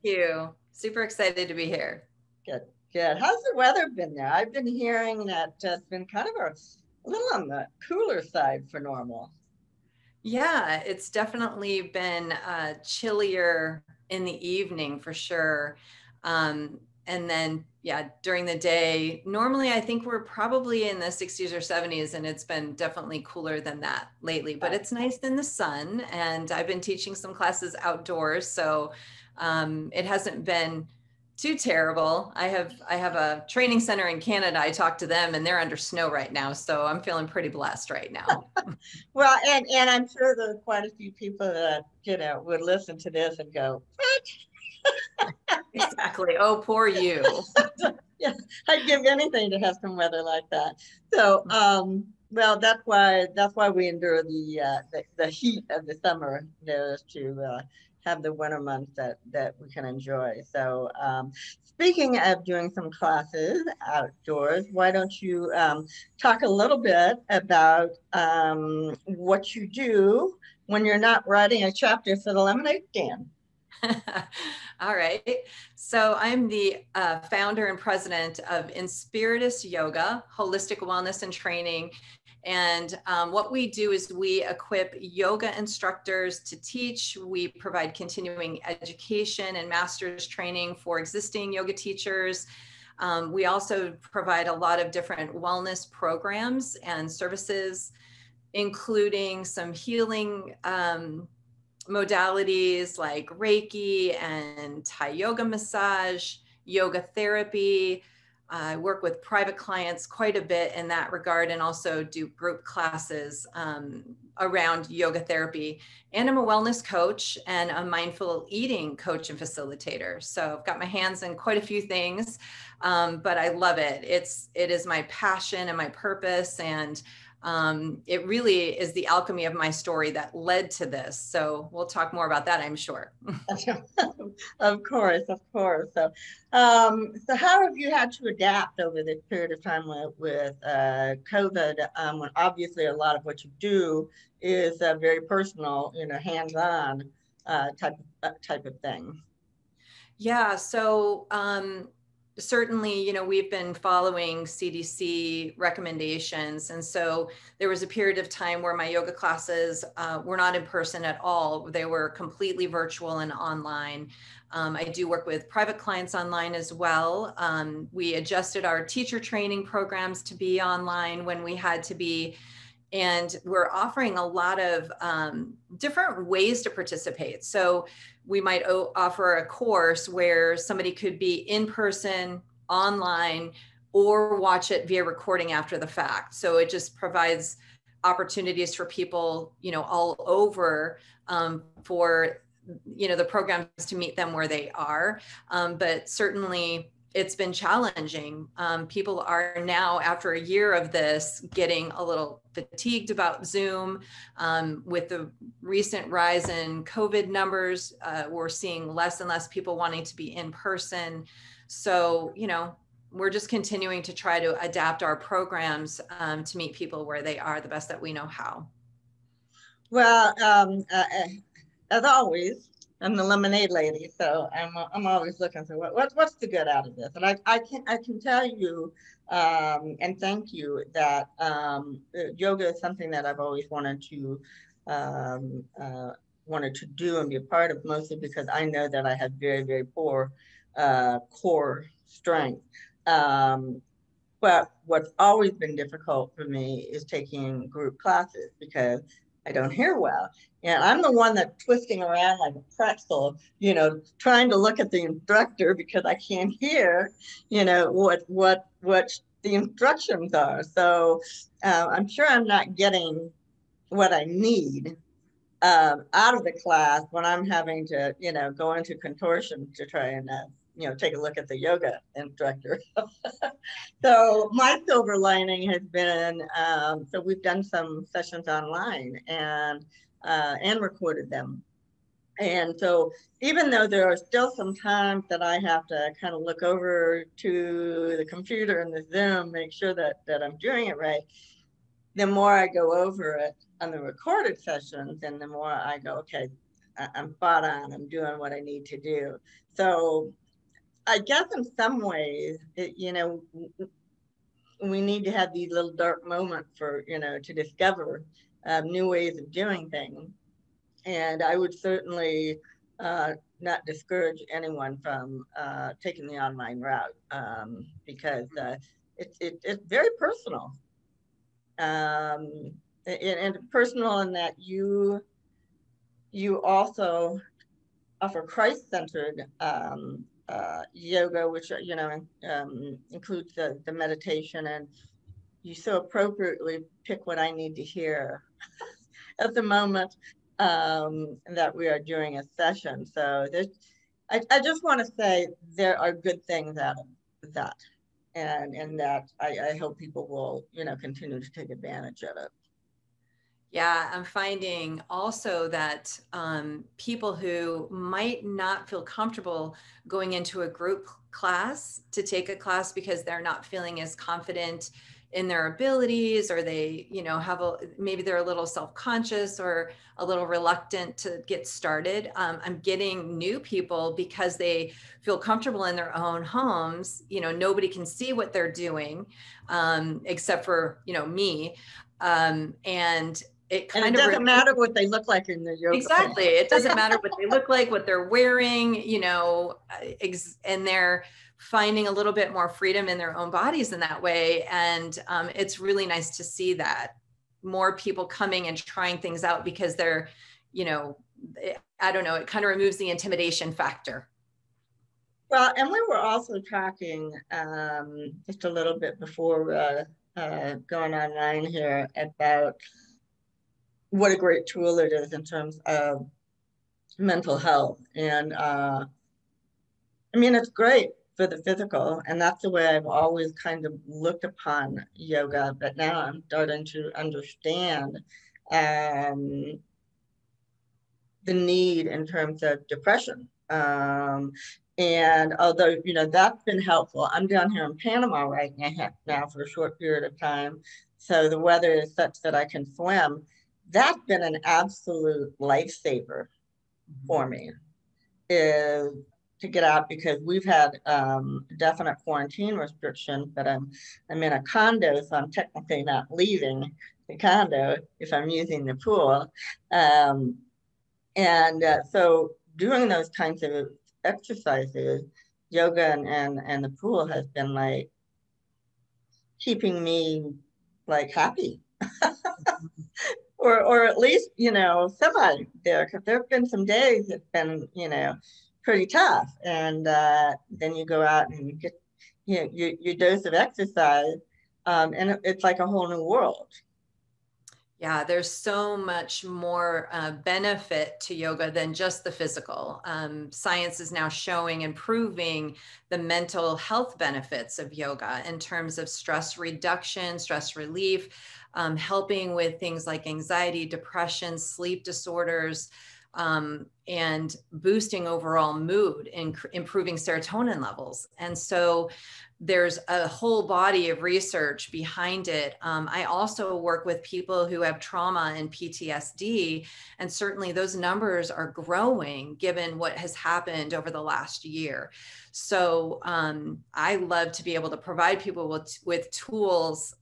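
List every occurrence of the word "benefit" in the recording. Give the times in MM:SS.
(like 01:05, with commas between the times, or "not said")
08:10, 08:17.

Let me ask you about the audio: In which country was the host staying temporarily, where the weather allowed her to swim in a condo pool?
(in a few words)
Panama.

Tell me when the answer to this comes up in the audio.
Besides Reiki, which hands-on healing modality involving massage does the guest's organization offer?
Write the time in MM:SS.
01:44.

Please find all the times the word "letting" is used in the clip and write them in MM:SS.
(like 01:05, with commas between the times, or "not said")
not said.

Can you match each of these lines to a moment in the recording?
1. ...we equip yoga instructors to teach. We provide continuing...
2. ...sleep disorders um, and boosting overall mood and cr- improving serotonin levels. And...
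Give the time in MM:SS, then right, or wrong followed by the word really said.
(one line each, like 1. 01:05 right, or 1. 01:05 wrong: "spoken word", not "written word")
1. 01:24 right
2. 08:24 right.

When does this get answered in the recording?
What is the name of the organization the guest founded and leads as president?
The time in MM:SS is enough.
01:18.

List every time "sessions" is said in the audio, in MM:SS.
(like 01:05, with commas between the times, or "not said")
04:38, 04:54, 05:42.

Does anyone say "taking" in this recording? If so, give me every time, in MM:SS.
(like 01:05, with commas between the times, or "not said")
04:07, 05:16.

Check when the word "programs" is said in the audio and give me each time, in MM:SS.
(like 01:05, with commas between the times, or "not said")
01:35, 02:49, 03:13, 03:35.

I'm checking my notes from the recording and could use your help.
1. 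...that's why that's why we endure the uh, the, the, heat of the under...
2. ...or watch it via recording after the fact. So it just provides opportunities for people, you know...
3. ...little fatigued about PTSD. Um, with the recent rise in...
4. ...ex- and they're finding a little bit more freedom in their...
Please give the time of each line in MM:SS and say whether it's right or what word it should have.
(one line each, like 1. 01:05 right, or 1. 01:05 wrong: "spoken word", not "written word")
1. 00:52 wrong: "summer", not "under"
2. 03:03 right
3. 03:22 wrong: "Zoom", not "PTSD"
4. 06:30 right.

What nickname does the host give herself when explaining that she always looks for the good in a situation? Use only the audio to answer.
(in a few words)
the lemonade lady.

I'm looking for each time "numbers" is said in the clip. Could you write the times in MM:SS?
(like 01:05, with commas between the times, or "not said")
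03:27, 08:40.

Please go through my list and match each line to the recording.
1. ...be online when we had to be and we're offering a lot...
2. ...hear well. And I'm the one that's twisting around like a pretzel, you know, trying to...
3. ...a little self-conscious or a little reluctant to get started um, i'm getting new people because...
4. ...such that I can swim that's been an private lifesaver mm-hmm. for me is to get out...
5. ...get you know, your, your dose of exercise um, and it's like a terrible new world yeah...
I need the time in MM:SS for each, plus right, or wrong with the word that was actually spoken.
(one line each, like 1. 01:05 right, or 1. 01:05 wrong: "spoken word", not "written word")
1. 02:50 right
2. 04:09 right
3. 06:08 right
4. 07:22 wrong: "absolute", not "private"
5. 08:01 wrong: "whole", not "terrible".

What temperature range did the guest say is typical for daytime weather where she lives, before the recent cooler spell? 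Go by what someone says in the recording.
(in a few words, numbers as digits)
60s or 70s.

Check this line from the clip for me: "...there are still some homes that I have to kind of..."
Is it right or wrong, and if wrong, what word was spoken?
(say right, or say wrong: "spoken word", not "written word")
wrong: "times", not "homes".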